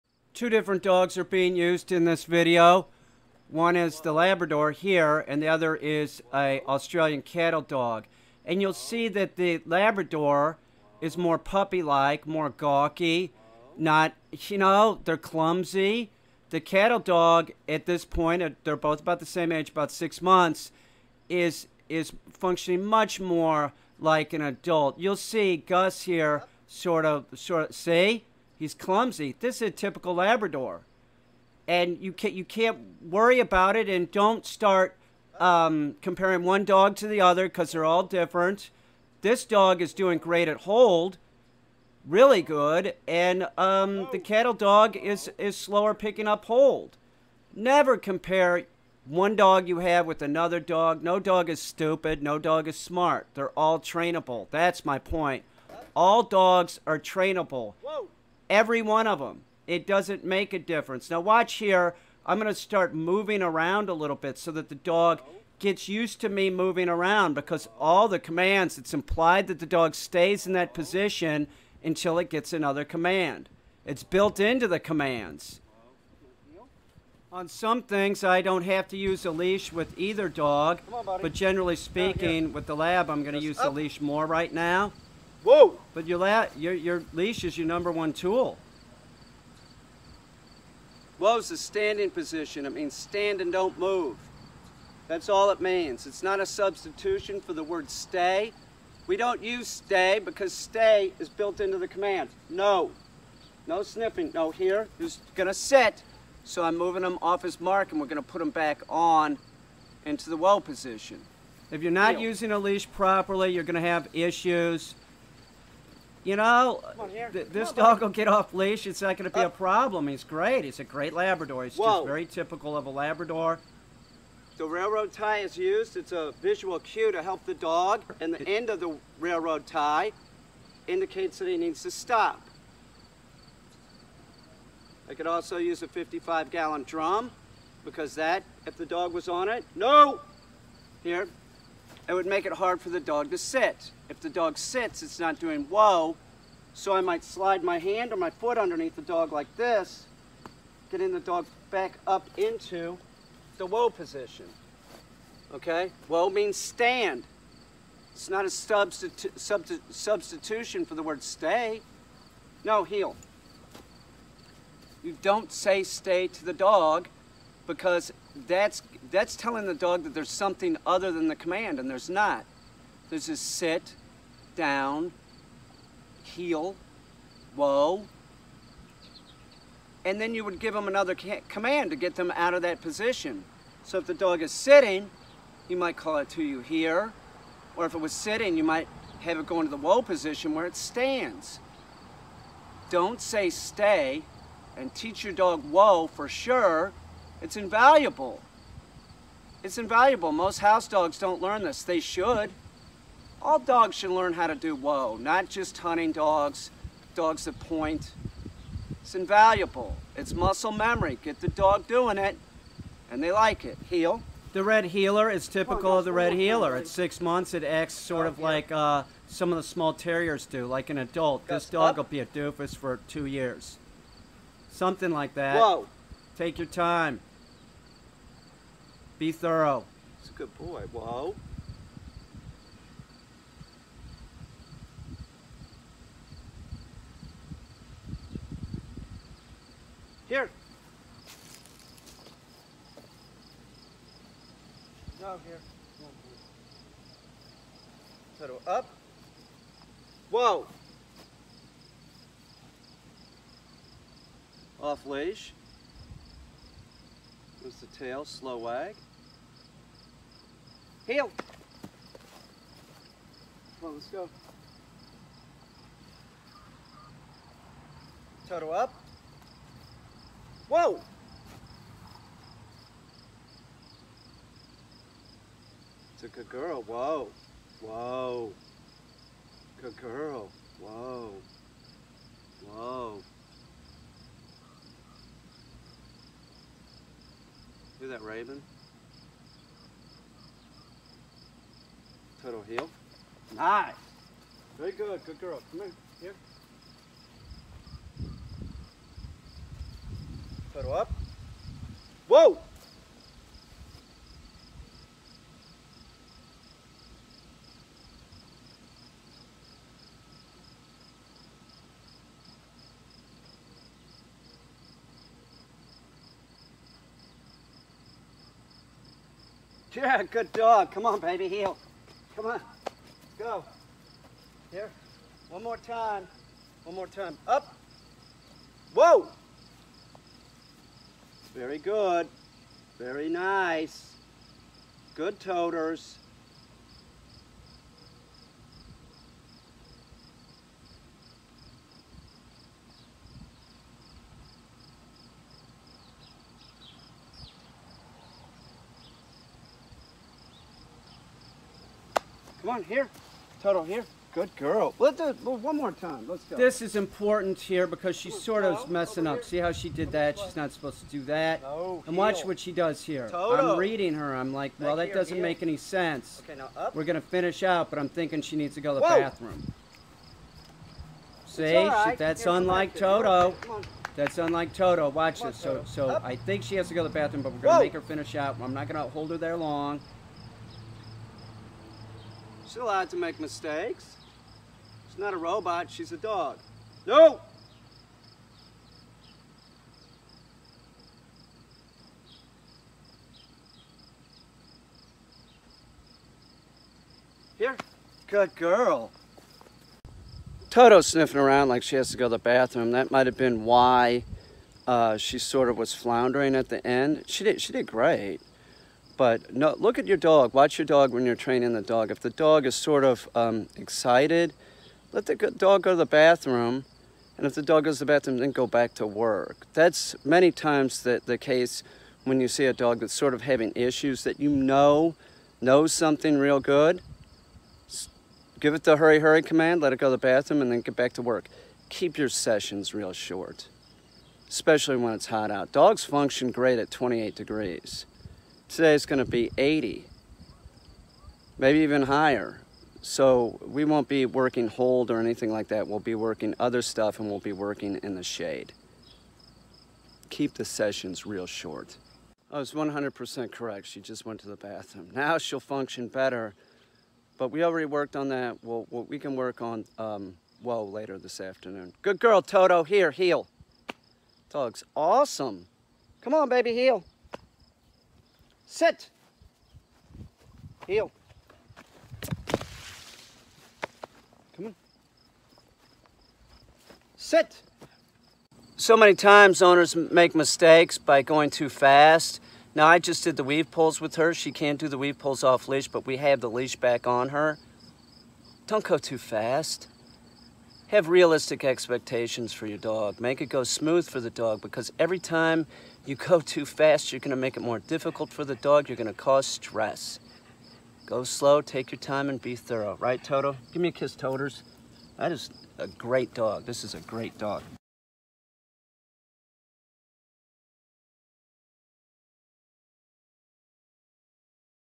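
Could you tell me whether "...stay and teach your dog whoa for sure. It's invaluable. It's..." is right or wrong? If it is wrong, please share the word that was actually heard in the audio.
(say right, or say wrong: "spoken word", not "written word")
right.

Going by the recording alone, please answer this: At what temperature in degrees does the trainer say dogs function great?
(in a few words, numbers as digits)
28.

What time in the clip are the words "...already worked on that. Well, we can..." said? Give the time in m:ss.
7:37.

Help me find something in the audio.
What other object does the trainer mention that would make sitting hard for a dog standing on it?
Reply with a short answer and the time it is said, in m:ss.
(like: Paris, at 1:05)
55 gallon drum, at 2:15.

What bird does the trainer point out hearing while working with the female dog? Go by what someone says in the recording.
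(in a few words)
raven.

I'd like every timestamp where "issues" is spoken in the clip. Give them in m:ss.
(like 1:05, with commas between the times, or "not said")
1:54, 7:03.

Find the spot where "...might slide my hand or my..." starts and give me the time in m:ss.
2:26.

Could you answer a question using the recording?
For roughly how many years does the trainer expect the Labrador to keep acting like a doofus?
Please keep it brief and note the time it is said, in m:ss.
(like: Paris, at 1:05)
2, at 3:43.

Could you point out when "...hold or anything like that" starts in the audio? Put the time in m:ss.
7:24.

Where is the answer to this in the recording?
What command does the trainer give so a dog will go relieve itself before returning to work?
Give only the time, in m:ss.
7:08.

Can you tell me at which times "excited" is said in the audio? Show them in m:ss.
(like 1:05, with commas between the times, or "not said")
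6:53.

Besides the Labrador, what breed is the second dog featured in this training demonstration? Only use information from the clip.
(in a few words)
Australian cattle dog.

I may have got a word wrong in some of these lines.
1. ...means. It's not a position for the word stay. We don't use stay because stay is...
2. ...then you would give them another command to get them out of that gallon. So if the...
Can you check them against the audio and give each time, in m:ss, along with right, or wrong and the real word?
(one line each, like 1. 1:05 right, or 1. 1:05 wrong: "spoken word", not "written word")
1. 1:35 wrong: "substitution", not "position"
2. 3:00 wrong: "position", not "gallon".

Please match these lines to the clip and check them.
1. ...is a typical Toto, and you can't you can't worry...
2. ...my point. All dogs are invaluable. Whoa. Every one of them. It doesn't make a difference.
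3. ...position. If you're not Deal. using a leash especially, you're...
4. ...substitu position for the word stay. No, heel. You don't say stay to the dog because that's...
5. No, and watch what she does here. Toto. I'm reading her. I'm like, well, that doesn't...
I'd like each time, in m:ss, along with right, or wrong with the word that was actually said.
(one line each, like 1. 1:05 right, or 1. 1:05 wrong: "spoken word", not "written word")
1. 0:29 wrong: "Labrador", not "Toto"
2. 0:54 wrong: "trainable", not "invaluable"
3. 1:50 wrong: "properly", not "especially"
4. 2:38 wrong: "substitution", not "position"
5. 6:01 right.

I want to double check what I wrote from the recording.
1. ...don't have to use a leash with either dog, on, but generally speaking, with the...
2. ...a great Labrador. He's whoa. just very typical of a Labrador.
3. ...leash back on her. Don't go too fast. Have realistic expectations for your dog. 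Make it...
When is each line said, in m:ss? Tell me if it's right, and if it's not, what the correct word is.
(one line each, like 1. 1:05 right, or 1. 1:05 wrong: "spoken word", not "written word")
1. 1:18 right
2. 2:00 right
3. 8:06 right.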